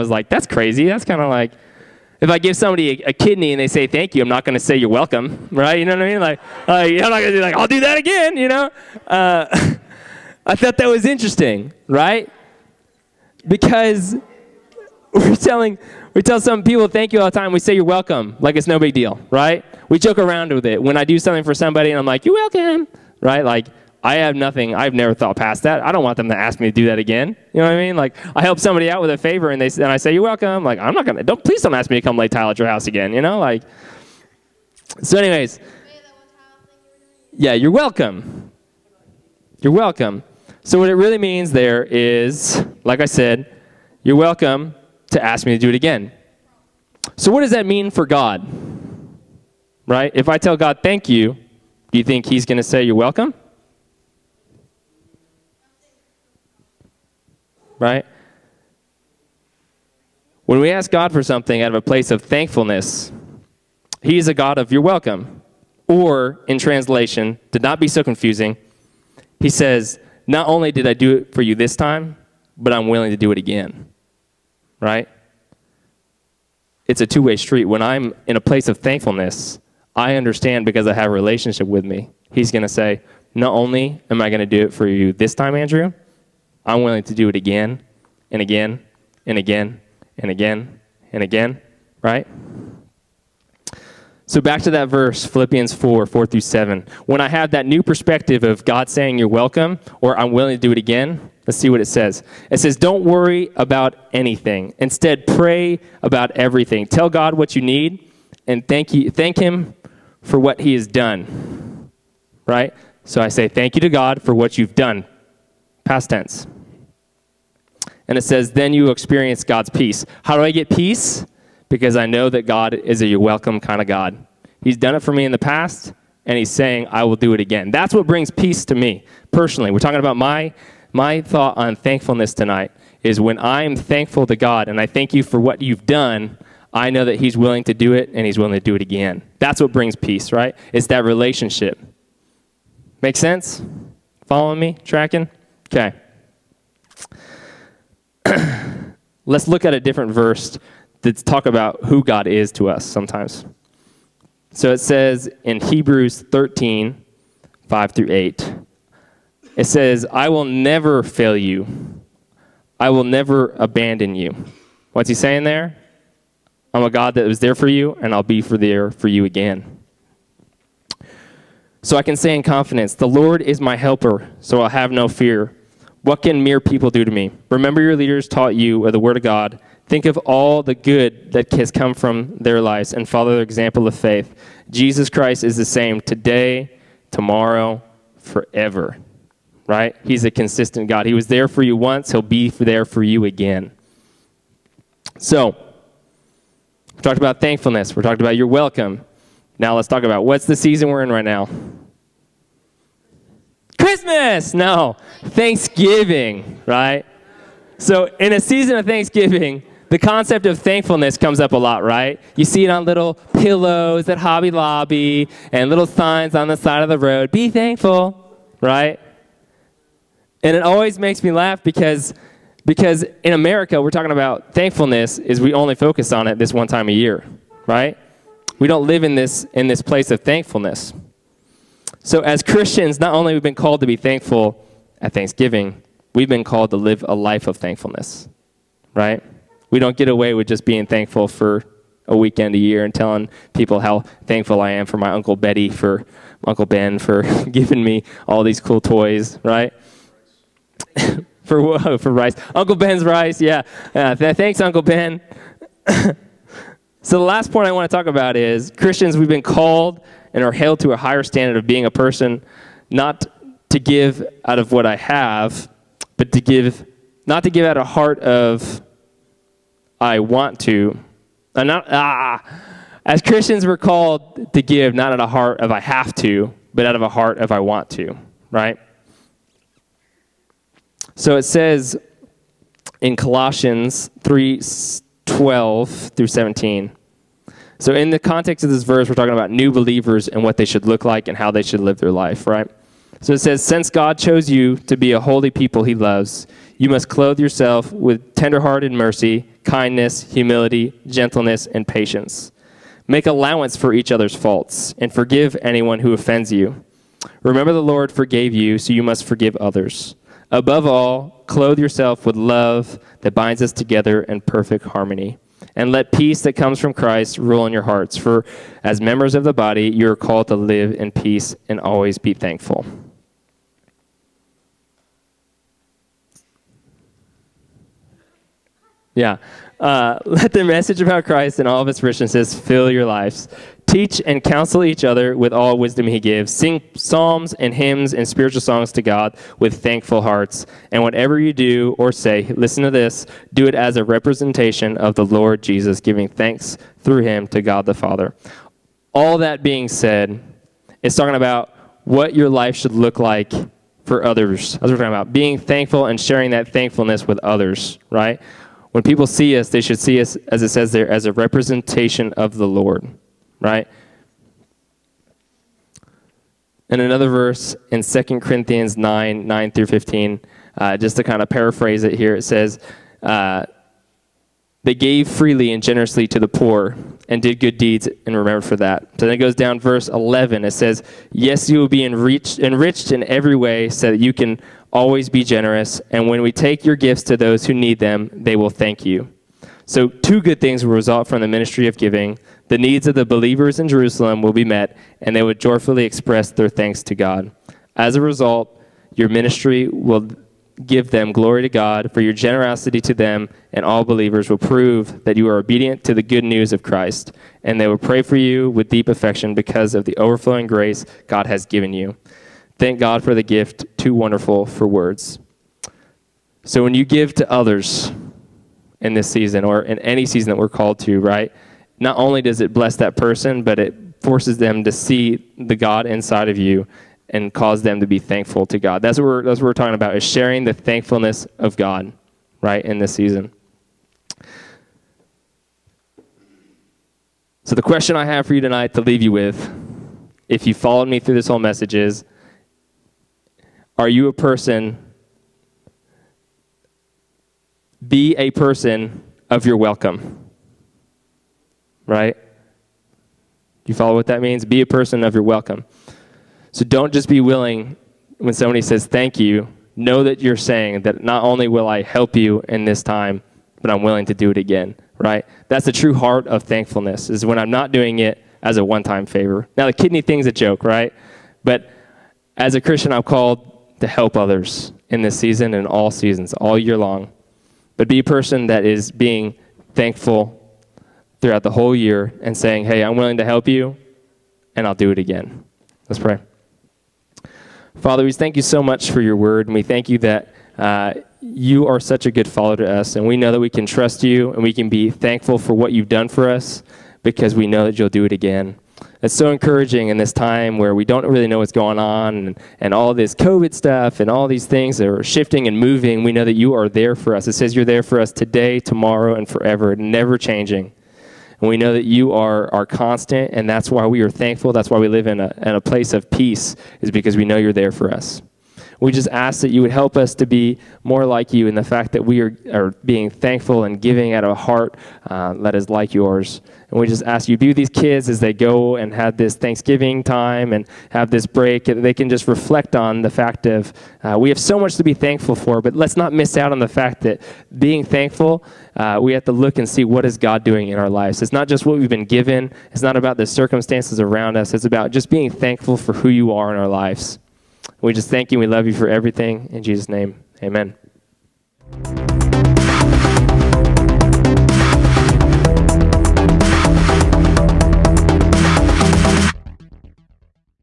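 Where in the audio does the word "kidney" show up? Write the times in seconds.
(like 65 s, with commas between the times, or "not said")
3 s, 469 s.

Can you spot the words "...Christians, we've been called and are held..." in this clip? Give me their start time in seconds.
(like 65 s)
258 s.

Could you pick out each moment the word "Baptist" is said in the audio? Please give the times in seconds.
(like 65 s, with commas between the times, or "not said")
not said.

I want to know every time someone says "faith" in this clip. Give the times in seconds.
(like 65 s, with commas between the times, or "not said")
183 s.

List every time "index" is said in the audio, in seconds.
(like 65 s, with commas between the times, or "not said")
not said.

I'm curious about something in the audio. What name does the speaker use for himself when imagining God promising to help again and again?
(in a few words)
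Andrew.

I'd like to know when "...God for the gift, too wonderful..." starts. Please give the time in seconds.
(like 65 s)
412 s.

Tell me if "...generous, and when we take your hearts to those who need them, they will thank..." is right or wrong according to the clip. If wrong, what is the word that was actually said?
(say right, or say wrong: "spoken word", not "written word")
wrong: "gifts", not "hearts".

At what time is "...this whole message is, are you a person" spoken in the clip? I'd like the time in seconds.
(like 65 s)
441 s.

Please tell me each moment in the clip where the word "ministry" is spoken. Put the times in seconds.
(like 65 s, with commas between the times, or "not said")
391 s, 399 s.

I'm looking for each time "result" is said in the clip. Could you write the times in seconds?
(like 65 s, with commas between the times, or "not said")
390 s, 398 s.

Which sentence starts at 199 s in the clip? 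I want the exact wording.
Now, let's talk about what's the season we're in right now?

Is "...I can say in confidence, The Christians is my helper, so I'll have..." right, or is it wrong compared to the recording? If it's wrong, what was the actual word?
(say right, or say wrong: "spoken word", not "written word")
wrong: "Lord", not "Christians".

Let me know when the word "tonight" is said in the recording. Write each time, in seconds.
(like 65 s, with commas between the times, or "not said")
132 s, 438 s.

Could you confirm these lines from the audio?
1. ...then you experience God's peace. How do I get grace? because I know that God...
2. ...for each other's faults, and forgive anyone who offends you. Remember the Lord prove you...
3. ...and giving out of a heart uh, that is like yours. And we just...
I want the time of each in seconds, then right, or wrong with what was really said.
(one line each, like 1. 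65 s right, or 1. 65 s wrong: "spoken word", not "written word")
1. 118 s wrong: "peace", not "grace"
2. 303 s wrong: "forgave", not "prove"
3. 523 s right.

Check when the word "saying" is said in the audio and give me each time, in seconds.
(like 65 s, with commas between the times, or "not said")
98 s, 126 s, 165 s, 460 s, 482 s.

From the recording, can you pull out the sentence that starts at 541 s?
It's not just what we've been given.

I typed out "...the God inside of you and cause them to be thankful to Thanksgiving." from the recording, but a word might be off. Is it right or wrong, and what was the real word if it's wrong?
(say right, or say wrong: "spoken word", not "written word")
wrong: "God", not "Thanksgiving".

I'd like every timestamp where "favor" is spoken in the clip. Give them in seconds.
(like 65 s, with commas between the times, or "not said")
29 s, 469 s.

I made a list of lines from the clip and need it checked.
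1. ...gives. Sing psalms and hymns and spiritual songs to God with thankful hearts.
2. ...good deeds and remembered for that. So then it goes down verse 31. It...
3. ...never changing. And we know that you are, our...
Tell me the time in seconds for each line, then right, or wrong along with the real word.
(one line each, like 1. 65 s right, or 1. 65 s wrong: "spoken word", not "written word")
1. 336 s right
2. 377 s wrong: "11", not "31"
3. 509 s right.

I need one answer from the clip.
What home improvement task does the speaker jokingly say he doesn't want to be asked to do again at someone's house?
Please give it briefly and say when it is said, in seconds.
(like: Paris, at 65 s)
Lay tile, at 32 s.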